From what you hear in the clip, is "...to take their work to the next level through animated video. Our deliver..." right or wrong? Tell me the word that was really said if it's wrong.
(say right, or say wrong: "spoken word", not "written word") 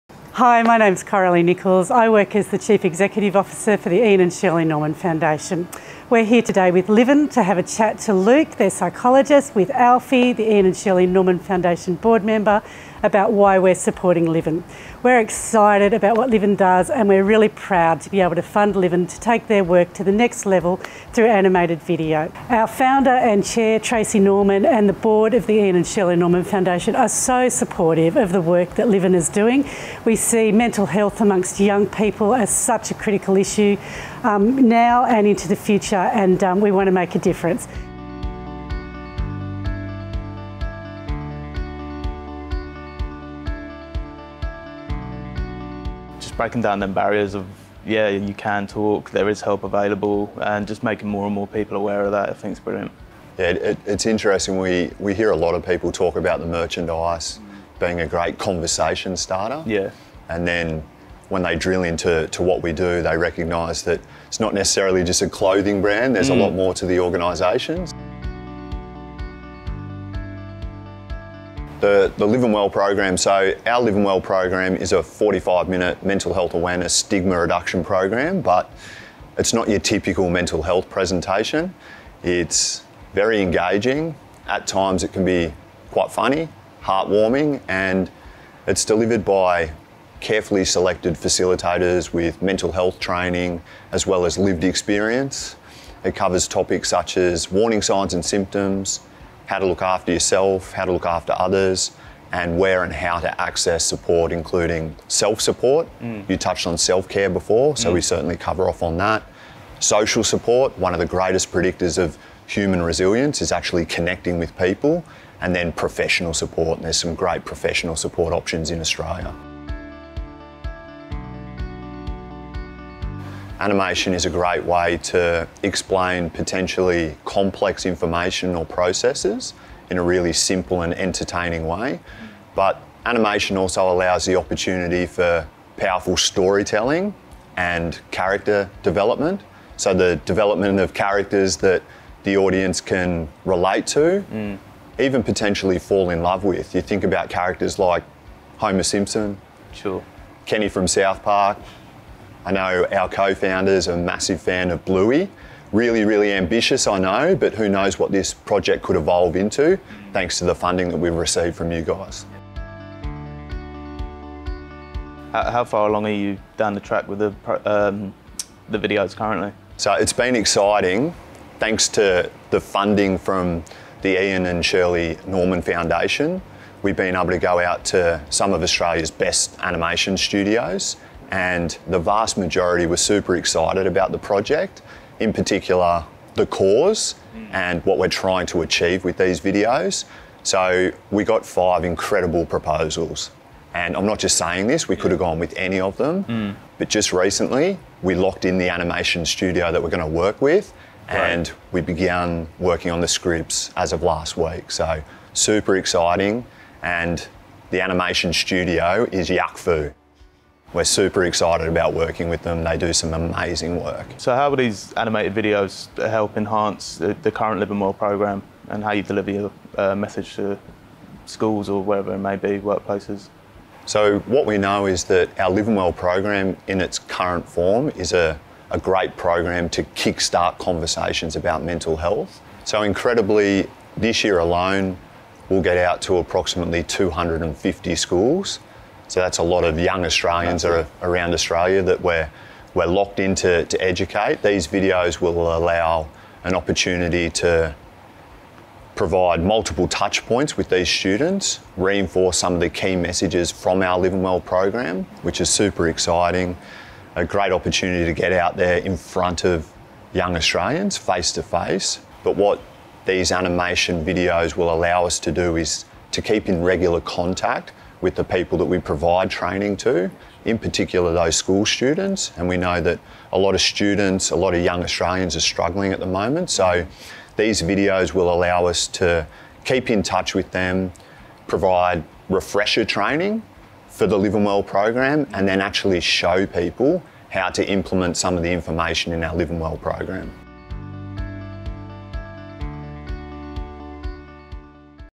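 wrong: "founder", not "deliver".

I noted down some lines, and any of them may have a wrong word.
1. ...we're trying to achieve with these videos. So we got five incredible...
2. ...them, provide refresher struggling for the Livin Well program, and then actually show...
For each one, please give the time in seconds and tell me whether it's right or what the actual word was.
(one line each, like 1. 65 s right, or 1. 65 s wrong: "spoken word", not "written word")
1. 187 s right
2. 280 s wrong: "training", not "struggling".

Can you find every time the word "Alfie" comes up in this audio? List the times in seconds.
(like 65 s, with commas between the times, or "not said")
9 s.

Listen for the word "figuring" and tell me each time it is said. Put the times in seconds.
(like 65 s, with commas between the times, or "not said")
not said.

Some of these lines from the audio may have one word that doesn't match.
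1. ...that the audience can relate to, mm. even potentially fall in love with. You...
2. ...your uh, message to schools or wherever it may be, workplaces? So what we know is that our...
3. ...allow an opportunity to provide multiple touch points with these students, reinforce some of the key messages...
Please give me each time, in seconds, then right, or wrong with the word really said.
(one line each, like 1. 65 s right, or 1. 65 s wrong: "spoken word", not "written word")
1. 141 s right
2. 219 s right
3. 245 s right.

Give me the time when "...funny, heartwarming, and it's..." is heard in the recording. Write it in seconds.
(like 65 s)
86 s.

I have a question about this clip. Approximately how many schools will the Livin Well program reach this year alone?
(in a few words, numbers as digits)
250.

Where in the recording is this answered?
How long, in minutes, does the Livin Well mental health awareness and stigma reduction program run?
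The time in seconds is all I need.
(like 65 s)
75 s.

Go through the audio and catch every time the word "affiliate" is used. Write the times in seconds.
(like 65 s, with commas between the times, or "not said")
not said.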